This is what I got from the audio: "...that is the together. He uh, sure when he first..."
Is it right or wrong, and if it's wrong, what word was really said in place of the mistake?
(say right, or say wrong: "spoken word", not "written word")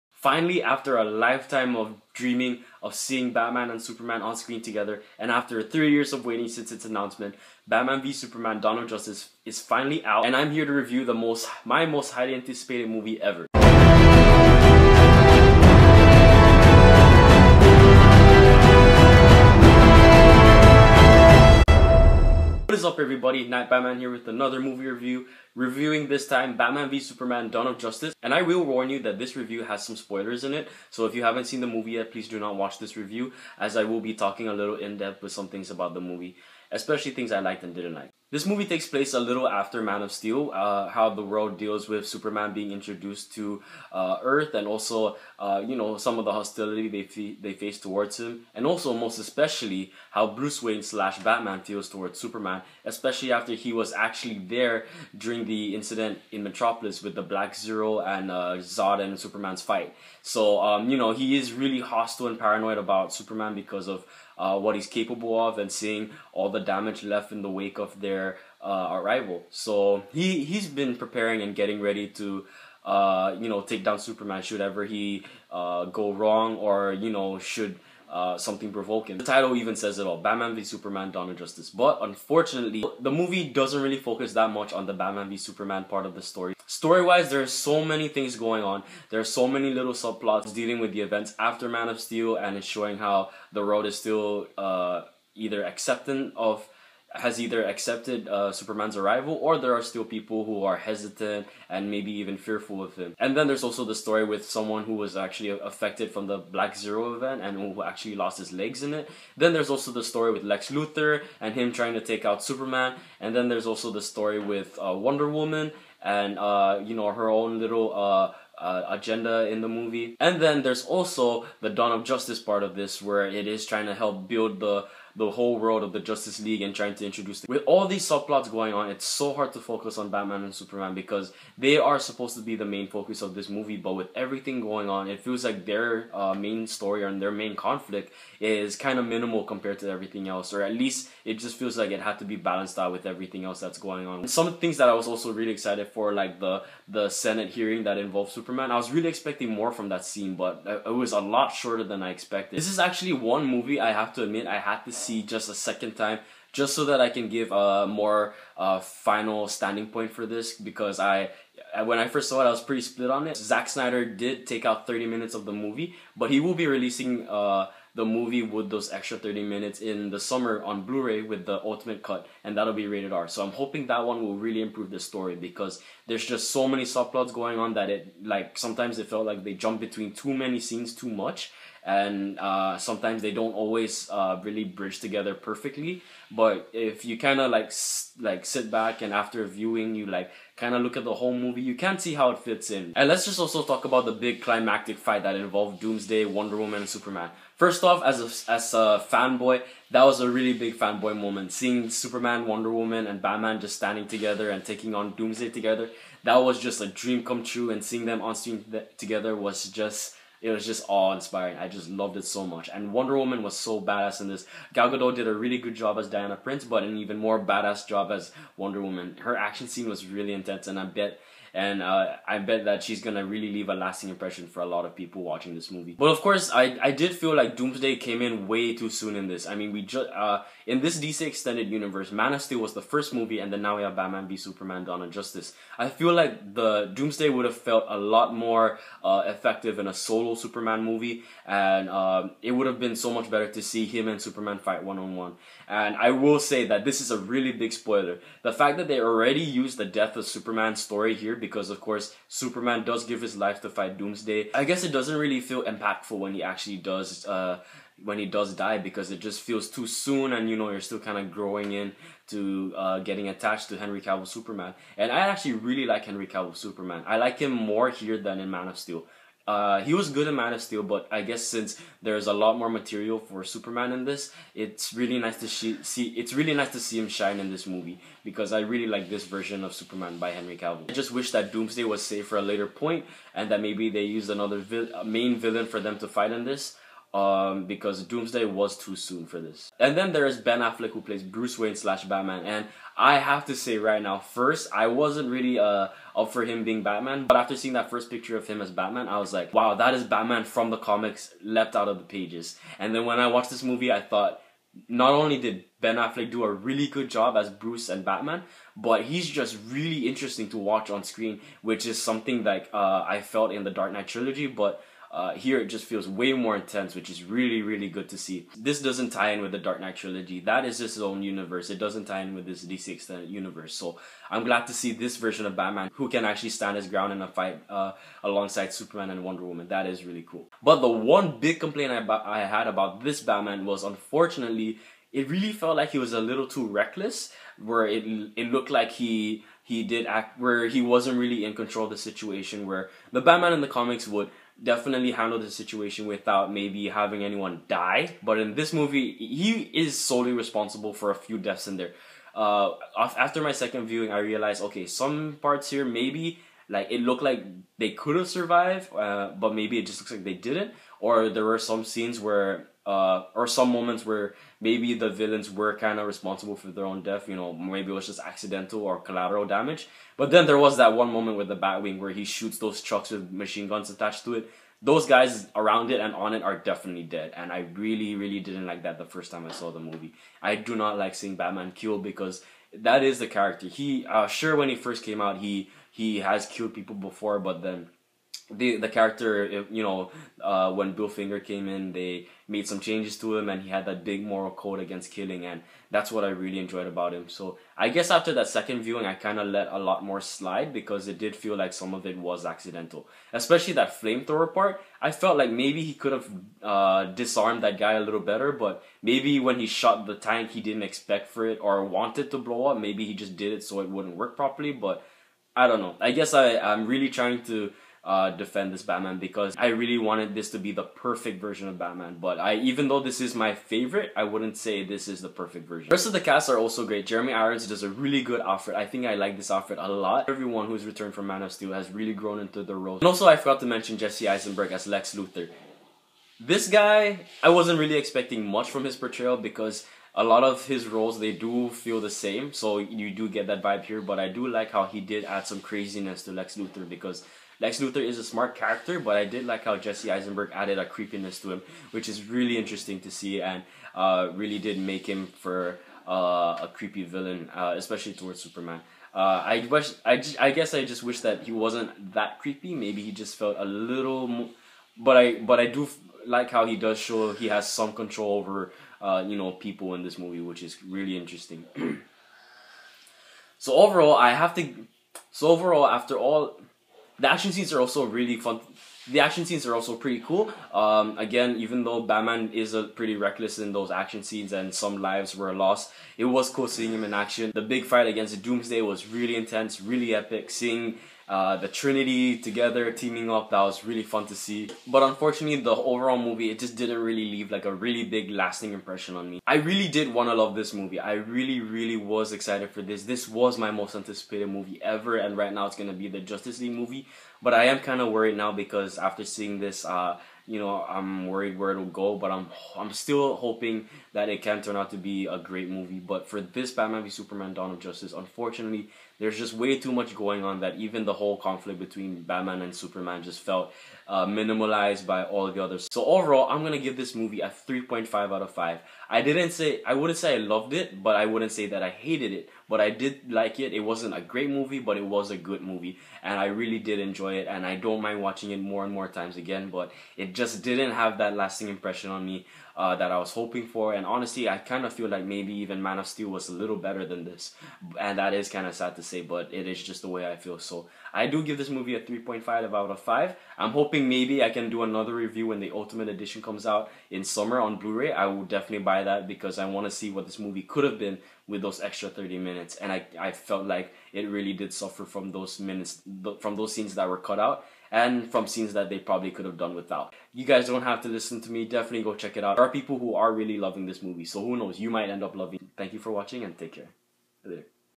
wrong: "character", not "together".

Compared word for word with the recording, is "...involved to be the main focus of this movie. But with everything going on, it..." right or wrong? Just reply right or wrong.
wrong.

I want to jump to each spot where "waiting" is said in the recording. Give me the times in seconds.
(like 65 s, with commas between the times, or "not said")
6 s.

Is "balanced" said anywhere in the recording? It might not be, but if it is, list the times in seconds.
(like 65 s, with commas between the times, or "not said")
142 s.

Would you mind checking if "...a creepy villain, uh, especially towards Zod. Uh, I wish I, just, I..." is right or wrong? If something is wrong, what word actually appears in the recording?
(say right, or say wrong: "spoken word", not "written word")
wrong: "Superman", not "Zod".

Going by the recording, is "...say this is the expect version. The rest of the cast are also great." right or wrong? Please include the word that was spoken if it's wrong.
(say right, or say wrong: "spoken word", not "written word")
wrong: "perfect", not "expect".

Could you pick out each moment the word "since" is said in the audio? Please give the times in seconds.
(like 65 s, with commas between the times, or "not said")
6 s, 271 s.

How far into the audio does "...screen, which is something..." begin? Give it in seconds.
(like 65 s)
311 s.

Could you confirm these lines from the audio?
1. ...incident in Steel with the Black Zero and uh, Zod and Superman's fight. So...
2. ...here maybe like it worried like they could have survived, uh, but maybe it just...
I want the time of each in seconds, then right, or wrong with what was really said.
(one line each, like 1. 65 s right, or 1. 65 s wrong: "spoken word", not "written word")
1. 55 s wrong: "Metropolis", not "Steel"
2. 355 s wrong: "looked", not "worried".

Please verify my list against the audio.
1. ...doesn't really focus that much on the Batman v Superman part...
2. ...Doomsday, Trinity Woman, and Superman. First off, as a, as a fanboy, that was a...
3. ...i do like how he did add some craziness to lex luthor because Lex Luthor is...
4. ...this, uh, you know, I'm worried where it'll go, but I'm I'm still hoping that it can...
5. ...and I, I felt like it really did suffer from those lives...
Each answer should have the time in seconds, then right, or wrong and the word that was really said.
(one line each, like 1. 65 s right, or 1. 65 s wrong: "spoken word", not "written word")
1. 83 s right
2. 195 s wrong: "Wonder", not "Trinity"
3. 444 s right
4. 509 s right
5. 562 s wrong: "minutes", not "lives".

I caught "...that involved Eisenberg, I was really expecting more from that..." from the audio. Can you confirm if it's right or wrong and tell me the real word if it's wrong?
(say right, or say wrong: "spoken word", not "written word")
wrong: "Superman", not "Eisenberg".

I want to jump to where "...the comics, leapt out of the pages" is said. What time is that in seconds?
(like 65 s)
300 s.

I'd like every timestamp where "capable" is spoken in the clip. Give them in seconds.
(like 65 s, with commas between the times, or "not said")
64 s.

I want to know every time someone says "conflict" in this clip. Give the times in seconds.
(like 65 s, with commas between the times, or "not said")
137 s, 521 s.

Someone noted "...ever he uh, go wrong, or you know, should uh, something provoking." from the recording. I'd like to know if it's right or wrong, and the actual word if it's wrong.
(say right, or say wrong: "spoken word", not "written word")
right.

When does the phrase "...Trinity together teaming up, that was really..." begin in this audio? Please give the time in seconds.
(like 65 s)
491 s.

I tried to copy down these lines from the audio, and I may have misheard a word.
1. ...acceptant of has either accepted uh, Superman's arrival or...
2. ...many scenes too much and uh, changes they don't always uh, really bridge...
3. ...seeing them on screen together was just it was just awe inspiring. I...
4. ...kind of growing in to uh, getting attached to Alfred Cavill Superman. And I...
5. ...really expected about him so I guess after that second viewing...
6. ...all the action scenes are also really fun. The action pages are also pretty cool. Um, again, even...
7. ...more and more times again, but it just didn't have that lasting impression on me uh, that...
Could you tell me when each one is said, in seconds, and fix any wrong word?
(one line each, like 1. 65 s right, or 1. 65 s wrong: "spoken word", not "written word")
1. 95 s right
2. 180 s wrong: "sometimes", not "changes"
3. 207 s right
4. 260 s wrong: "Henry", not "Alfred"
5. 396 s wrong: "enjoyed", not "expected"
6. 476 s wrong: "scenes", not "pages"
7. 538 s right.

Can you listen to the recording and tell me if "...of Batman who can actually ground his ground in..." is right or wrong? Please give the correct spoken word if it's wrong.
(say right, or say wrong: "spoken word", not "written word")
wrong: "stand", not "ground".